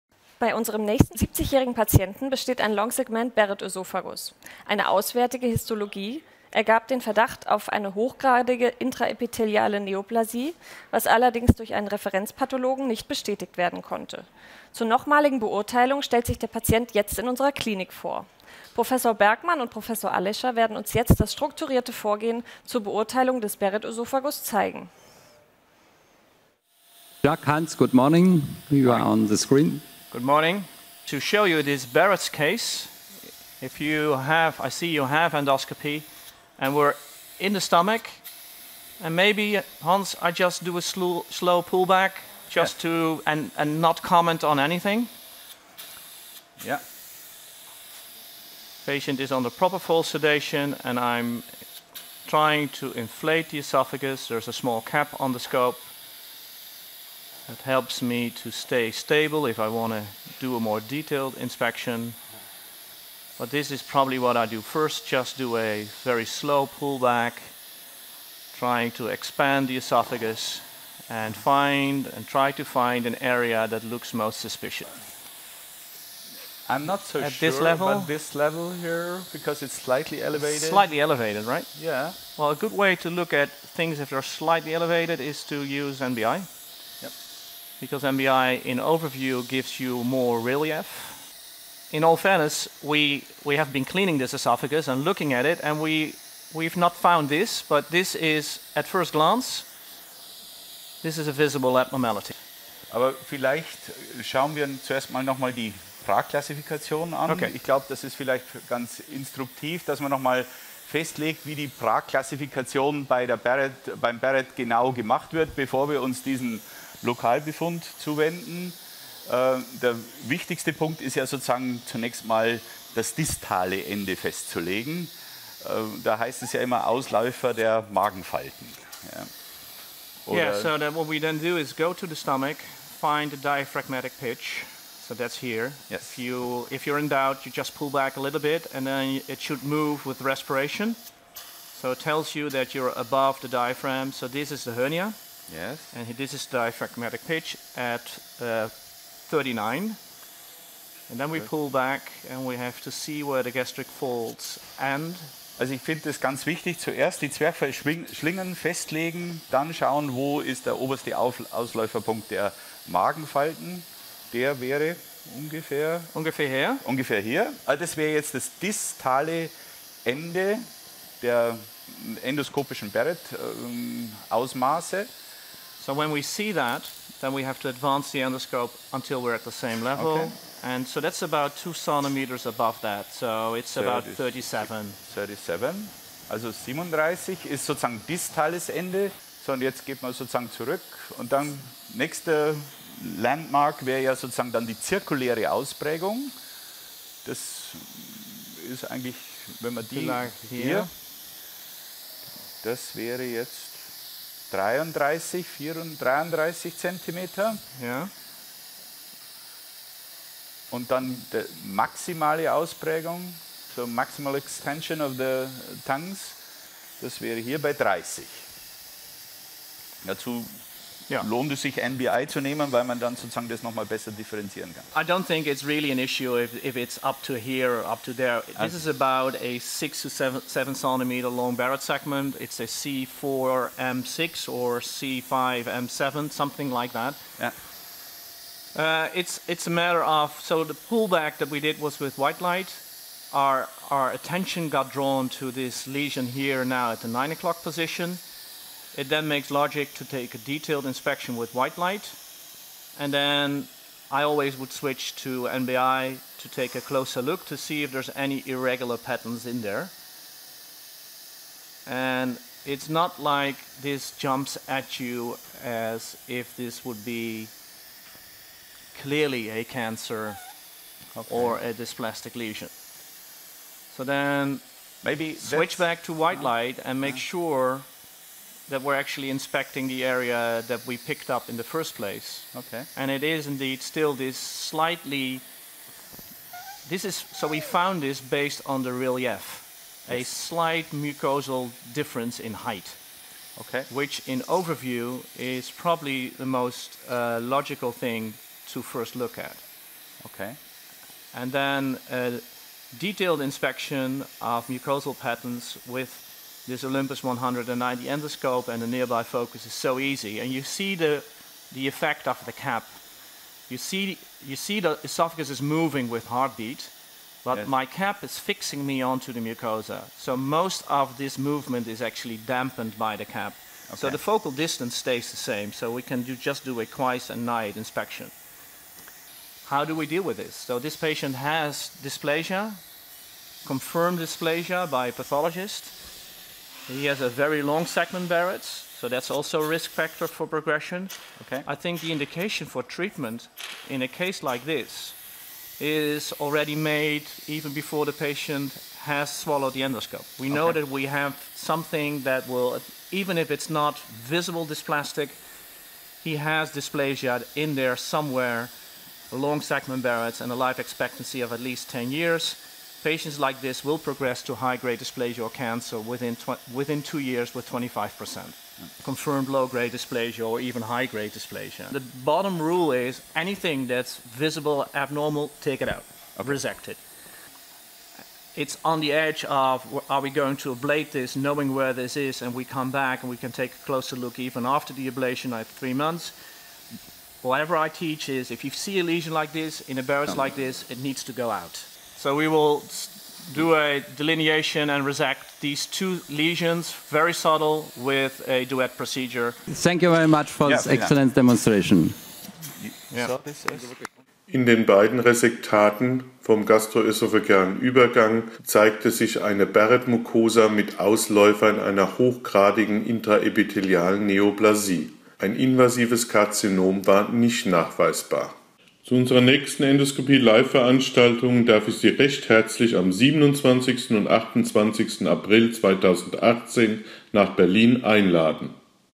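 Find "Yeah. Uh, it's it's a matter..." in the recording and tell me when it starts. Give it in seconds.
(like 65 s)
237 s.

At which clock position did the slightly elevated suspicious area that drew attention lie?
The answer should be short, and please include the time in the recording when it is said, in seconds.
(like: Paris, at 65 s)
9 o'clock, at 247 s.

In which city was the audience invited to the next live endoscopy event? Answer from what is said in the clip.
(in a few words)
Berlin.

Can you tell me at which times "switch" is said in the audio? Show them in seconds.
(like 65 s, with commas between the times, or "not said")
254 s, 275 s.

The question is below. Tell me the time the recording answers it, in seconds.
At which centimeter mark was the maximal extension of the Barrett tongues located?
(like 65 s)
217 s.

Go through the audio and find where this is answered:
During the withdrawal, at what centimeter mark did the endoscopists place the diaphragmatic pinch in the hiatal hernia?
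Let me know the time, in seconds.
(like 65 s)
149 s.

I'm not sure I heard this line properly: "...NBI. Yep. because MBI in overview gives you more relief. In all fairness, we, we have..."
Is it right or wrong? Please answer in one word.
right.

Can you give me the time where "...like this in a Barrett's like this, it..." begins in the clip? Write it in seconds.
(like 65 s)
389 s.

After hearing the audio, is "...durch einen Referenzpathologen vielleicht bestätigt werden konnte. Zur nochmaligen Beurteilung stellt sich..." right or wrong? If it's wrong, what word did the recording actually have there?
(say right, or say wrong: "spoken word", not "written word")
wrong: "nicht", not "vielleicht".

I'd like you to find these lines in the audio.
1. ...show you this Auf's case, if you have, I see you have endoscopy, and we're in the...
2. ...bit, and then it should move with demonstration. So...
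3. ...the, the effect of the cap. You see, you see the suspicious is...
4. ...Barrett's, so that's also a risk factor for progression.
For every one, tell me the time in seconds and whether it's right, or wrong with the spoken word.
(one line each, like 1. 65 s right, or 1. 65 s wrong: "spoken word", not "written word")
1. 31 s wrong: "Barrett", not "Auf"
2. 138 s wrong: "respiration", not "demonstration"
3. 310 s wrong: "esophagus", not "suspicious"
4. 338 s right.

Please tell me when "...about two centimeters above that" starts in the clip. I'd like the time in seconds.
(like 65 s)
181 s.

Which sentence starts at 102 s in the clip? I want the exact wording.
Aber vielleicht schauen wir zuerst mal nochmal die Pragklassifikation an.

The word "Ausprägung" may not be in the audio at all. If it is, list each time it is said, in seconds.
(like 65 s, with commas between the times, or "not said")
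195 s, 212 s.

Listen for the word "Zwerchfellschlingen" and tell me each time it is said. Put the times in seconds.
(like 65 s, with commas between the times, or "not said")
157 s.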